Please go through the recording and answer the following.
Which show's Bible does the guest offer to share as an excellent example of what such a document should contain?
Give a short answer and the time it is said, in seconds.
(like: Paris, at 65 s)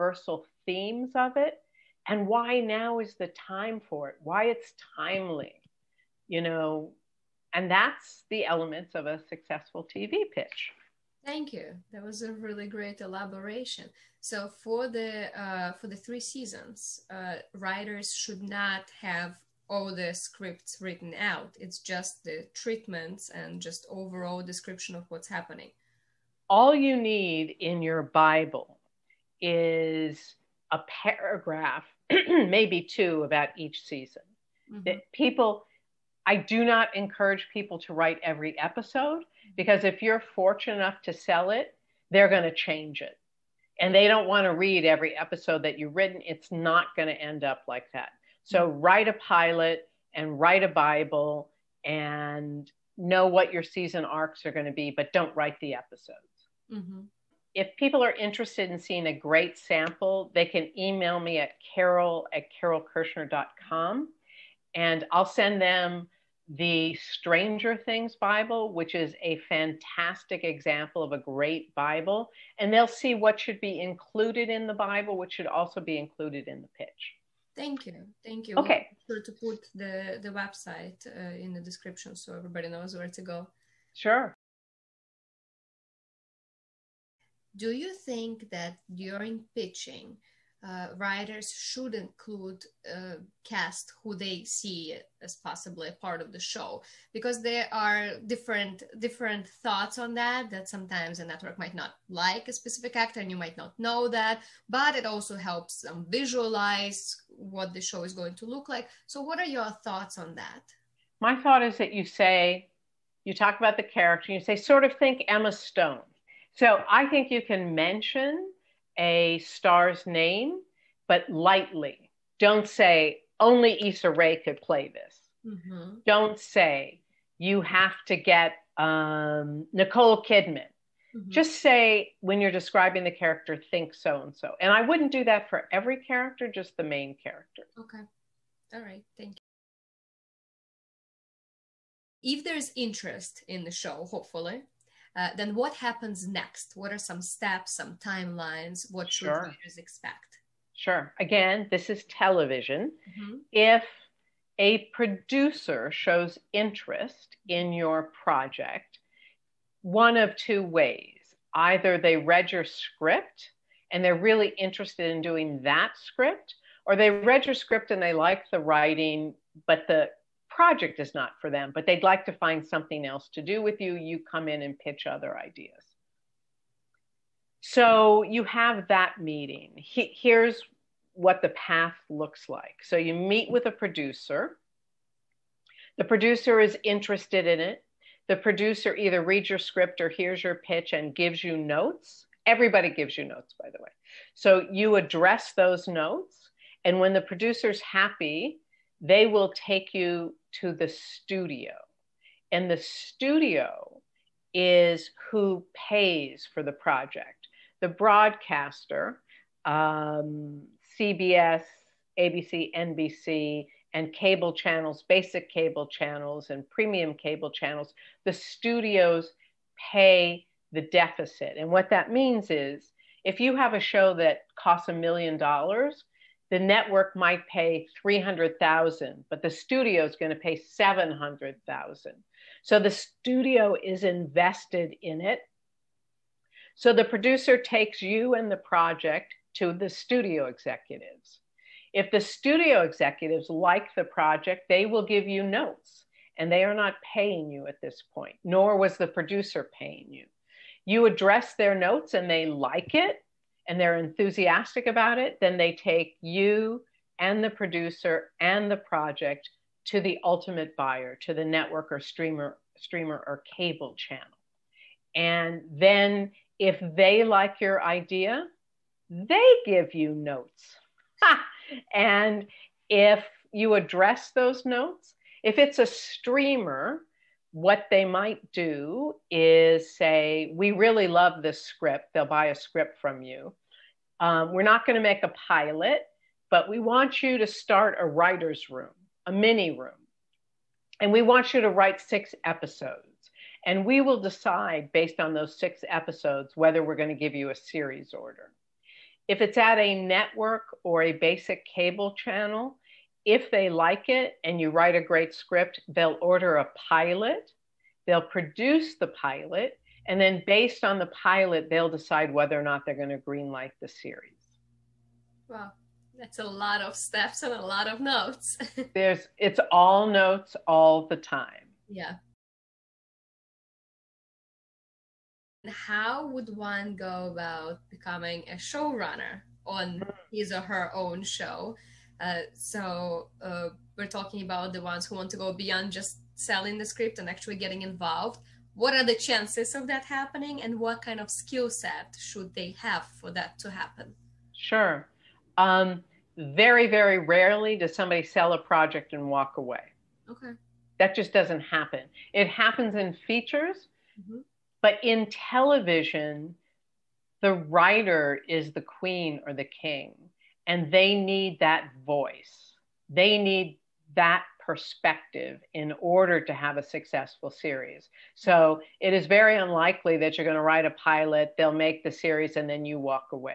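Stranger Things, at 66 s.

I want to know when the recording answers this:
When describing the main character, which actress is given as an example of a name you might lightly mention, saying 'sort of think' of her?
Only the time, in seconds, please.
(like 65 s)
115 s.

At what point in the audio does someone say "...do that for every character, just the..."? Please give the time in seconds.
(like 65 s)
135 s.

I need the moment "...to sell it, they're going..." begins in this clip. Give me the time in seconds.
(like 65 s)
41 s.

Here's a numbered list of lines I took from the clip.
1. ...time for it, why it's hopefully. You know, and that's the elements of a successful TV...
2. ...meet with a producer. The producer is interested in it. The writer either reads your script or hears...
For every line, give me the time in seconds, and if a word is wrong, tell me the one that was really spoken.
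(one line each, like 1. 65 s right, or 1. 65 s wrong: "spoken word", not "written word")
1. 3 s wrong: "timely", not "hopefully"
2. 183 s wrong: "producer", not "writer".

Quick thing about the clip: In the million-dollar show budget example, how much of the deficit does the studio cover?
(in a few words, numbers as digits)
700,000.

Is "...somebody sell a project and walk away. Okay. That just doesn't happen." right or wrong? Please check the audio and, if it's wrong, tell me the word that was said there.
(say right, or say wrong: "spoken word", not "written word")
right.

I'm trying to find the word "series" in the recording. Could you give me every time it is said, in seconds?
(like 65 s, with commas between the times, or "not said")
297 s, 313 s, 367 s, 372 s.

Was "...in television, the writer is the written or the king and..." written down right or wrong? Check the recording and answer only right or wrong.
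wrong.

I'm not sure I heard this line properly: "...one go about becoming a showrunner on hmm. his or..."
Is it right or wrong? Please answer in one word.
right.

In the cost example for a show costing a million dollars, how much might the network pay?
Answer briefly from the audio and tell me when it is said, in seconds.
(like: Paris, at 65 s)
300,000, at 228 s.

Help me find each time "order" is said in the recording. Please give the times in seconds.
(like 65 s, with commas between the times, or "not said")
298 s, 306 s, 366 s.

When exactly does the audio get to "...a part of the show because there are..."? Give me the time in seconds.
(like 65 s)
95 s.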